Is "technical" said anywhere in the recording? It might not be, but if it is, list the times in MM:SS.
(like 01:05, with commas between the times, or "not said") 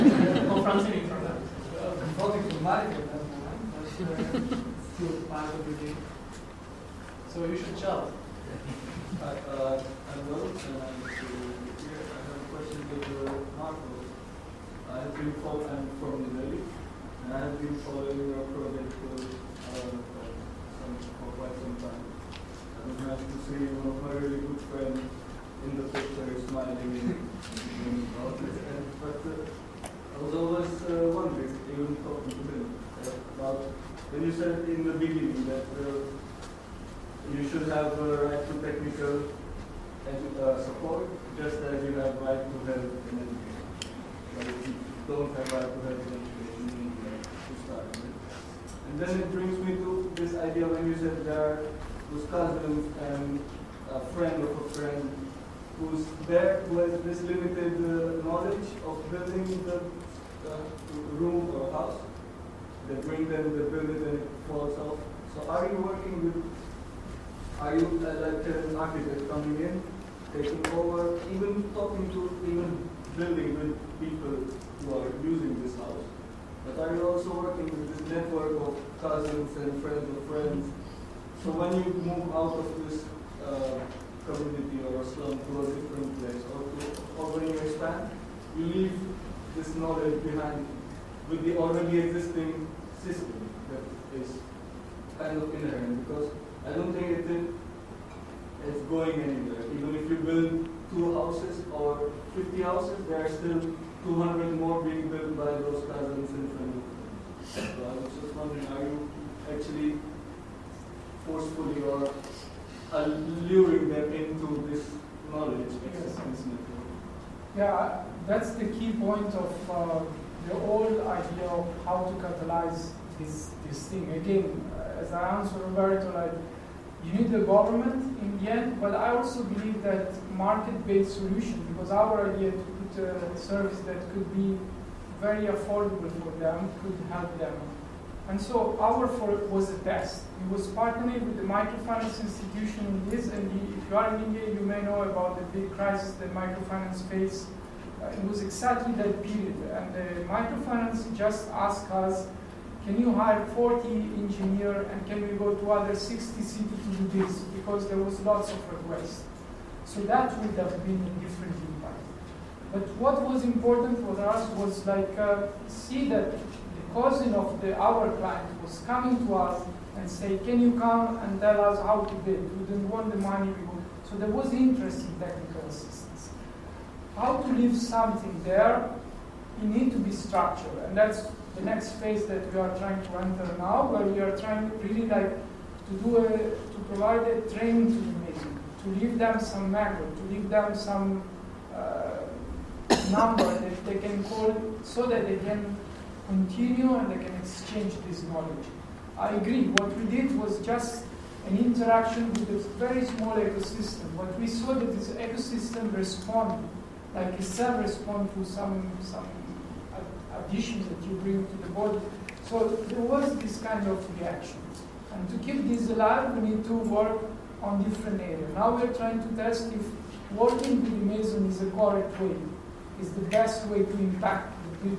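00:38, 02:55.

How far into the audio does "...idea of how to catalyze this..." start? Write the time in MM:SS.
02:01.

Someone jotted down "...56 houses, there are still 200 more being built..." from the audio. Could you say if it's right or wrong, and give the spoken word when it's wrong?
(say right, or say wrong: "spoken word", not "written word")
wrong: "50", not "56".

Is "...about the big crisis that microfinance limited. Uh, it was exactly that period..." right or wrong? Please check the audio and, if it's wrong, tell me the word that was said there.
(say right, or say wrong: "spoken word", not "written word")
wrong: "faced", not "limited".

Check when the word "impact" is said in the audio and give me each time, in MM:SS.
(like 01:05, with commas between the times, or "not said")
02:41, 03:44.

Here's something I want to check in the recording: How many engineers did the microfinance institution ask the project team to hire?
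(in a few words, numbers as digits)
40.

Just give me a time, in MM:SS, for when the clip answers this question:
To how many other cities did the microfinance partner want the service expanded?
02:35.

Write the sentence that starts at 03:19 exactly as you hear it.
I agree, what we did was just an interaction with a very small ecosystem.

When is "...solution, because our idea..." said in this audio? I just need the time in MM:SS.
02:11.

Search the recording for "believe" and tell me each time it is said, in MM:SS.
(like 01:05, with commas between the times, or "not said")
02:09.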